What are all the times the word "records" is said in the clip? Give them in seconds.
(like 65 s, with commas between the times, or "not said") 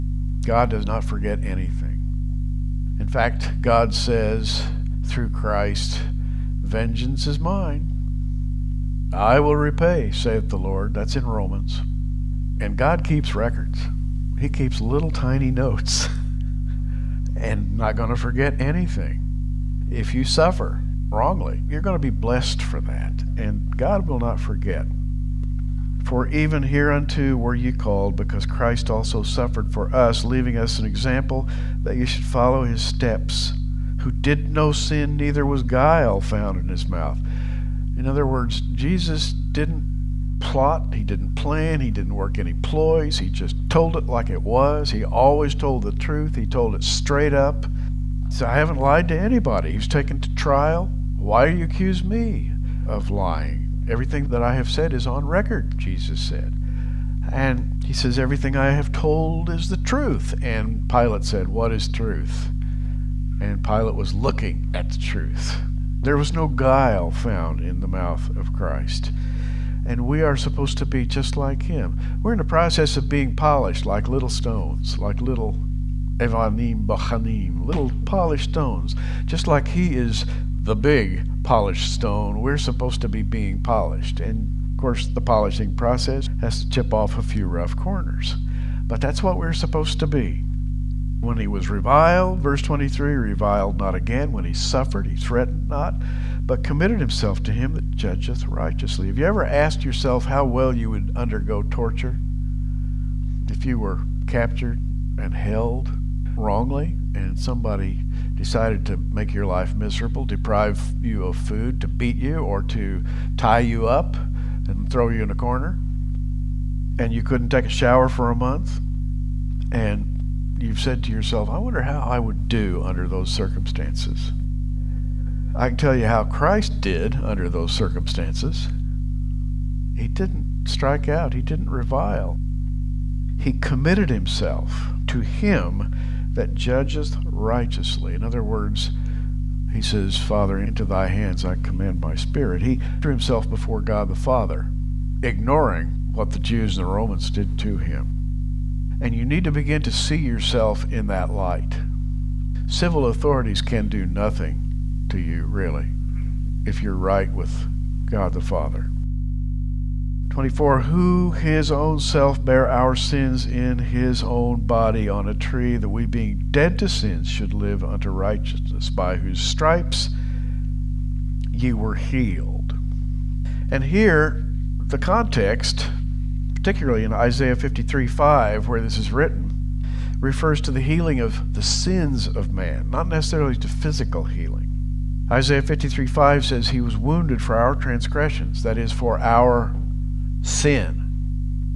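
13 s, 55 s.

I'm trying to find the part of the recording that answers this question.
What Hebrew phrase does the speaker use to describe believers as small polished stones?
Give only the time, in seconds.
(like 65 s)
76 s.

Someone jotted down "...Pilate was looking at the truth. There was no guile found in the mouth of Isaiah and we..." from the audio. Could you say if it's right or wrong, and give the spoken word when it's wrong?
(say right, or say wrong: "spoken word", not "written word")
wrong: "Christ", not "Isaiah".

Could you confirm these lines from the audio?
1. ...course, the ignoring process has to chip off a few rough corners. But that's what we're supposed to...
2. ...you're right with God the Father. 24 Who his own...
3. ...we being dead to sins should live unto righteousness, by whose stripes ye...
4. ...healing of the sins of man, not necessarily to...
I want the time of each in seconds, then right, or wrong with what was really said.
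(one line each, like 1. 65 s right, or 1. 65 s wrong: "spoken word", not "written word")
1. 84 s wrong: "polishing", not "ignoring"
2. 156 s right
3. 165 s right
4. 180 s right.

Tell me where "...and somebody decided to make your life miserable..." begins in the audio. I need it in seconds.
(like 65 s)
107 s.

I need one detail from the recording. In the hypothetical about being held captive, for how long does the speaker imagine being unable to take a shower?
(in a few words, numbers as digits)
a month.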